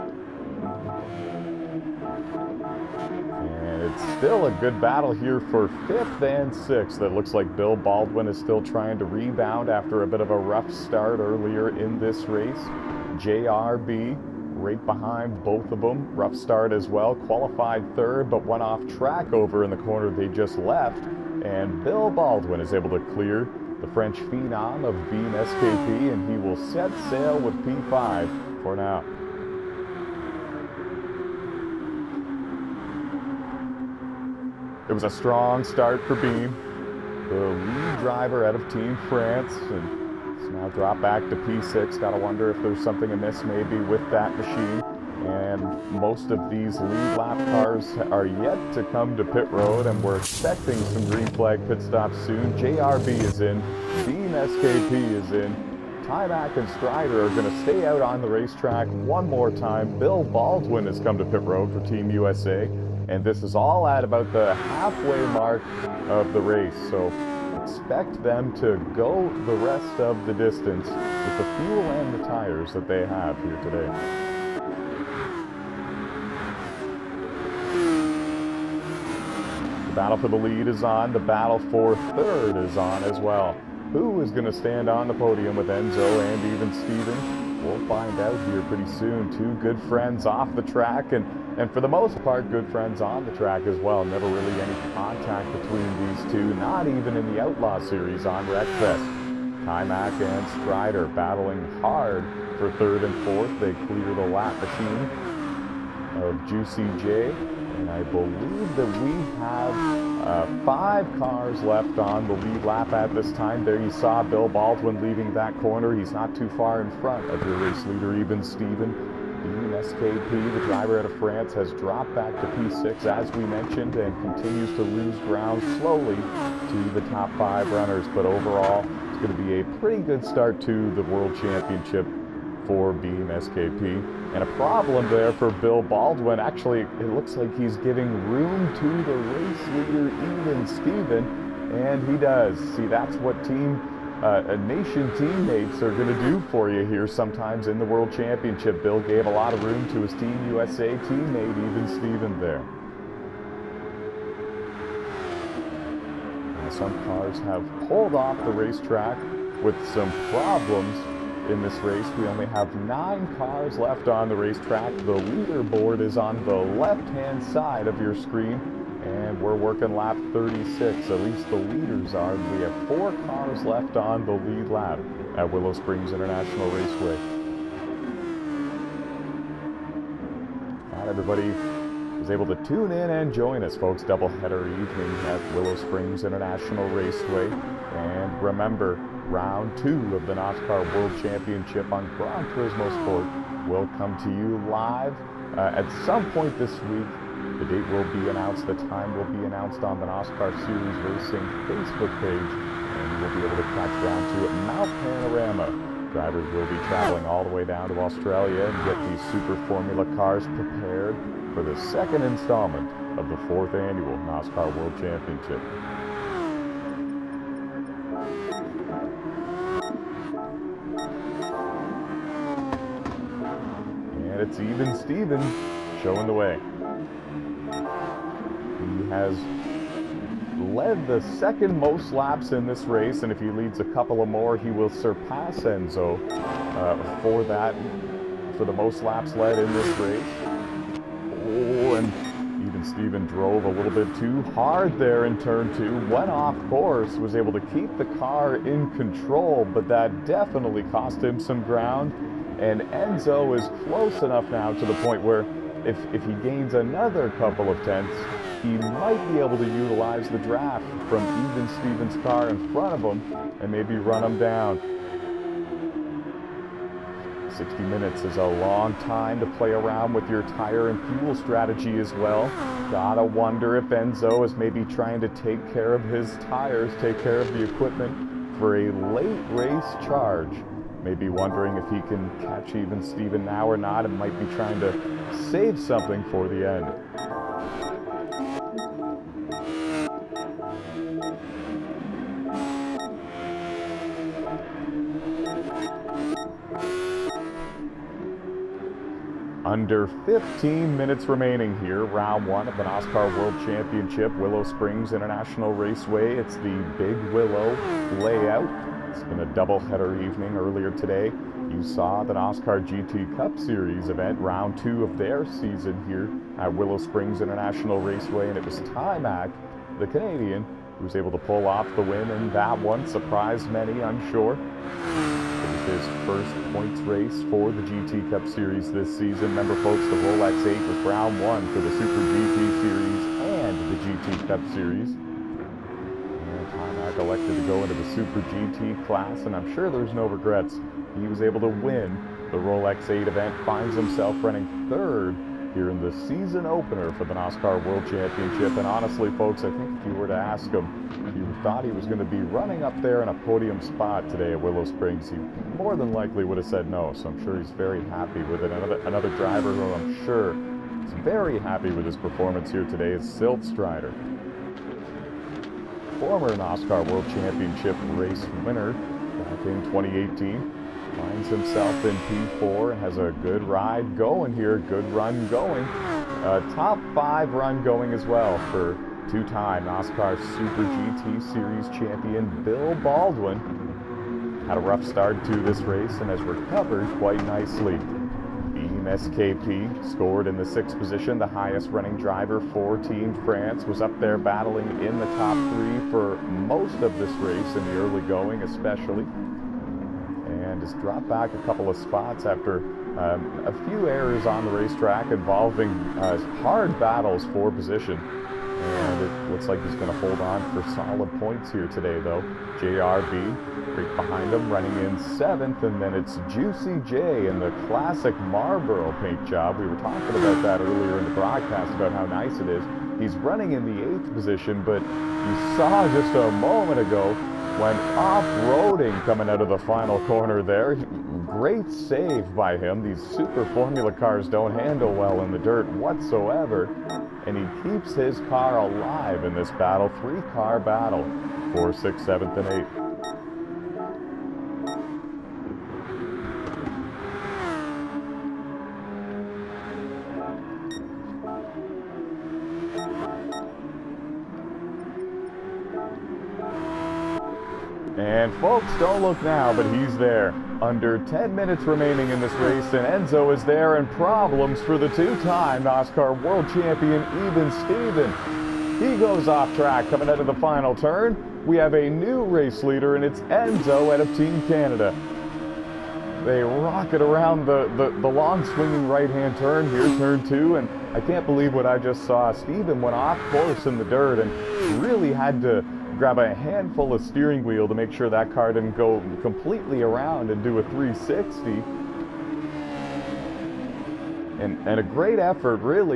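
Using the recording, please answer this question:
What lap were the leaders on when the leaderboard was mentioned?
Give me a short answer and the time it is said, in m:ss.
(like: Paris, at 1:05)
36, at 2:49.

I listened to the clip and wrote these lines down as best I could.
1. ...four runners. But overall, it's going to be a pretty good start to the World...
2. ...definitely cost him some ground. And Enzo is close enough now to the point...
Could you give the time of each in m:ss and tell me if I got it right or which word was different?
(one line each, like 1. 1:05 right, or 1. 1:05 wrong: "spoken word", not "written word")
1. 2:07 wrong: "five", not "four"
2. 4:10 right.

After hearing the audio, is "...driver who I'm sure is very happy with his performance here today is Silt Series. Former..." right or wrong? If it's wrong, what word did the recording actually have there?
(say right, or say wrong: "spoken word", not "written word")
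wrong: "Strider", not "Series".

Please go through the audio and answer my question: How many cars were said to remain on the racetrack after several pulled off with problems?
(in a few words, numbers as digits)
9.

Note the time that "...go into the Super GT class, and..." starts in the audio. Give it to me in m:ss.
5:37.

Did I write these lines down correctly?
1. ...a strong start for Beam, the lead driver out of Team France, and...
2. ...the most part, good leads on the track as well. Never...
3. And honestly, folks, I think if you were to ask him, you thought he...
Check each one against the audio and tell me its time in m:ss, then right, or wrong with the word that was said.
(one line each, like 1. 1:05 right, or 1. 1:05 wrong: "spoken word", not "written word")
1. 0:35 right
2. 1:31 wrong: "friends", not "leads"
3. 5:48 right.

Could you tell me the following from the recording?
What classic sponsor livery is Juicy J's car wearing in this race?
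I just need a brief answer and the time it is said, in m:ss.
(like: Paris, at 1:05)
Marlboro, at 6:58.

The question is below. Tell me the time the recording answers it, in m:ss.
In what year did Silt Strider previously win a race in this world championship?
6:09.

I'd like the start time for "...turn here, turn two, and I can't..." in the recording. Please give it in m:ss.
7:59.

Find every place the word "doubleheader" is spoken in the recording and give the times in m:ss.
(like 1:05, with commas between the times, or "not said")
3:04, 5:09.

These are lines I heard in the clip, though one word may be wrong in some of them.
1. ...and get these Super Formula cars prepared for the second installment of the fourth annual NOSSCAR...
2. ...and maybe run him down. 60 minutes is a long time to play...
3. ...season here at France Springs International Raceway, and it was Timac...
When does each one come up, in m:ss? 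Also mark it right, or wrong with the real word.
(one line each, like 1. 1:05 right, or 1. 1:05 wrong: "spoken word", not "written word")
1. 3:28 right
2. 4:23 right
3. 5:15 wrong: "Willow", not "France".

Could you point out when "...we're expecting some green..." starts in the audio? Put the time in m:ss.
0:50.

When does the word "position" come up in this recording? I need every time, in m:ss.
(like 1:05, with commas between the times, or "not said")
6:30, 6:47, 7:04.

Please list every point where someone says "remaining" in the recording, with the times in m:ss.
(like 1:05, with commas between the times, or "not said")
5:01, 7:41.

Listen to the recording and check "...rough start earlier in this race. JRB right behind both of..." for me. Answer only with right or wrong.
right.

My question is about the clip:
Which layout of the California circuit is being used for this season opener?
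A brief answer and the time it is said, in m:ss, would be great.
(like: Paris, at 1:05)
Big Willow, at 5:06.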